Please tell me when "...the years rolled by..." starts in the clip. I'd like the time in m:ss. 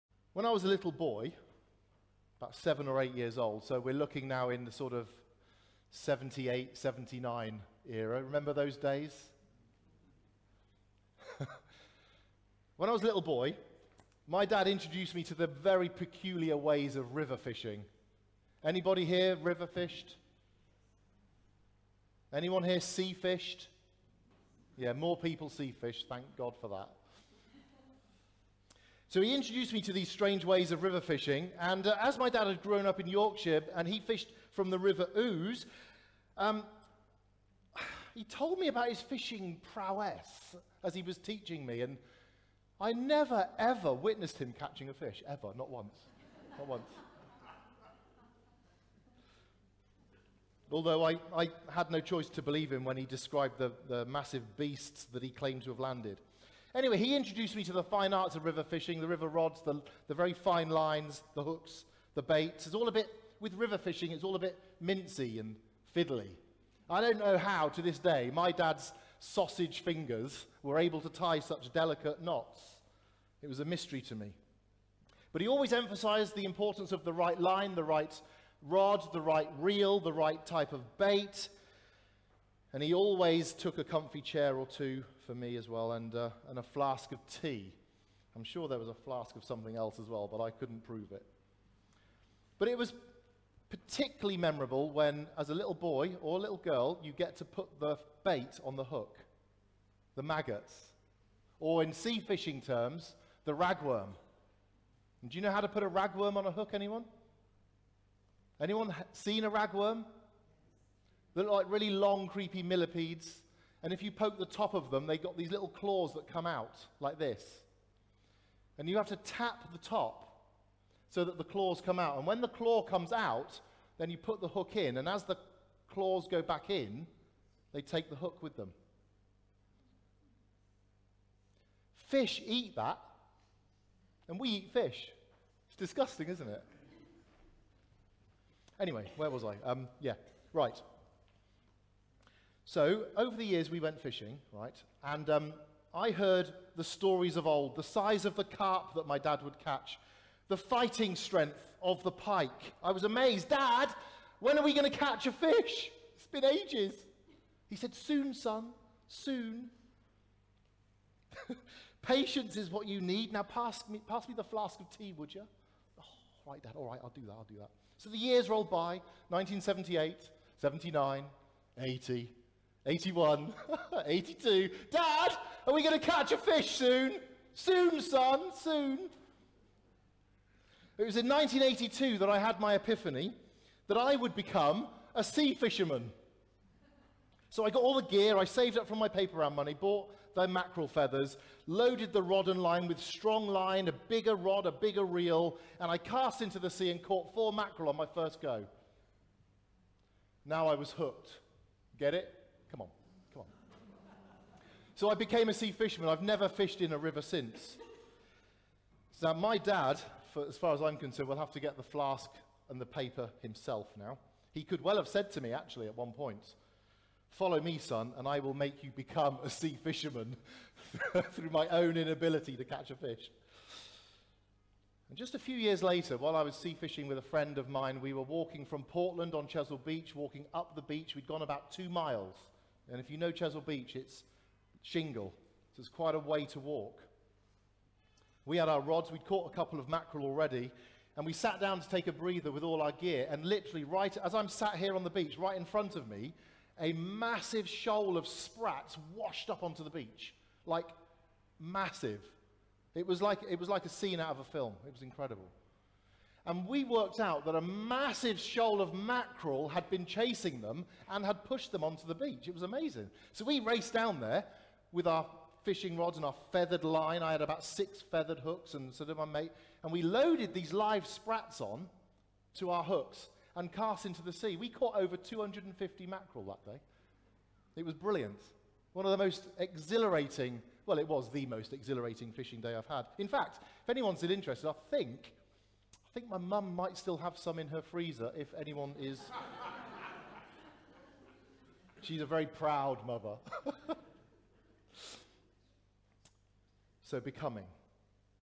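2:48.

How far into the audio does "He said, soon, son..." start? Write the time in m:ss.
2:37.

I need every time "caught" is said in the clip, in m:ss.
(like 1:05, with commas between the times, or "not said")
3:17, 3:59, 4:34.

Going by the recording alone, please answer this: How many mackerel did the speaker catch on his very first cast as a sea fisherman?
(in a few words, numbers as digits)
4.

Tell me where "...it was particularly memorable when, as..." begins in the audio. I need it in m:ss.
1:32.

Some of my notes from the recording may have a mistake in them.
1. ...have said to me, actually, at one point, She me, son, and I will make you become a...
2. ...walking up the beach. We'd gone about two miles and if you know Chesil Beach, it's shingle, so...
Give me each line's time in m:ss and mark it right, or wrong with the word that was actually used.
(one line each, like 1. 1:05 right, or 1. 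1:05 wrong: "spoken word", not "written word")
1. 3:34 wrong: "Follow", not "She"
2. 3:50 right.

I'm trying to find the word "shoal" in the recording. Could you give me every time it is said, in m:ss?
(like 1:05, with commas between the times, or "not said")
4:07, 4:18.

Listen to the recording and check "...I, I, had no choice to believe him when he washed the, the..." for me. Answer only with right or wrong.
wrong.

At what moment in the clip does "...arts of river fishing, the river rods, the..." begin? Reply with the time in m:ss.
0:58.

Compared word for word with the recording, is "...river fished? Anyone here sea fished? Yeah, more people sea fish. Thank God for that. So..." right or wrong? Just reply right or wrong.
right.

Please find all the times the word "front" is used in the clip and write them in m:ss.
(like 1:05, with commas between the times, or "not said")
4:05.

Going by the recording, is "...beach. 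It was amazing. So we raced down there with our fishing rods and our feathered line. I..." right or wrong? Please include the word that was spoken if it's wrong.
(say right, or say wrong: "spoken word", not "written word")
right.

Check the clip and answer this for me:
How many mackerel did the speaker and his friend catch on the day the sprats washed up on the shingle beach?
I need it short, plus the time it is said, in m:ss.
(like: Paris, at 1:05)
over 250, at 4:34.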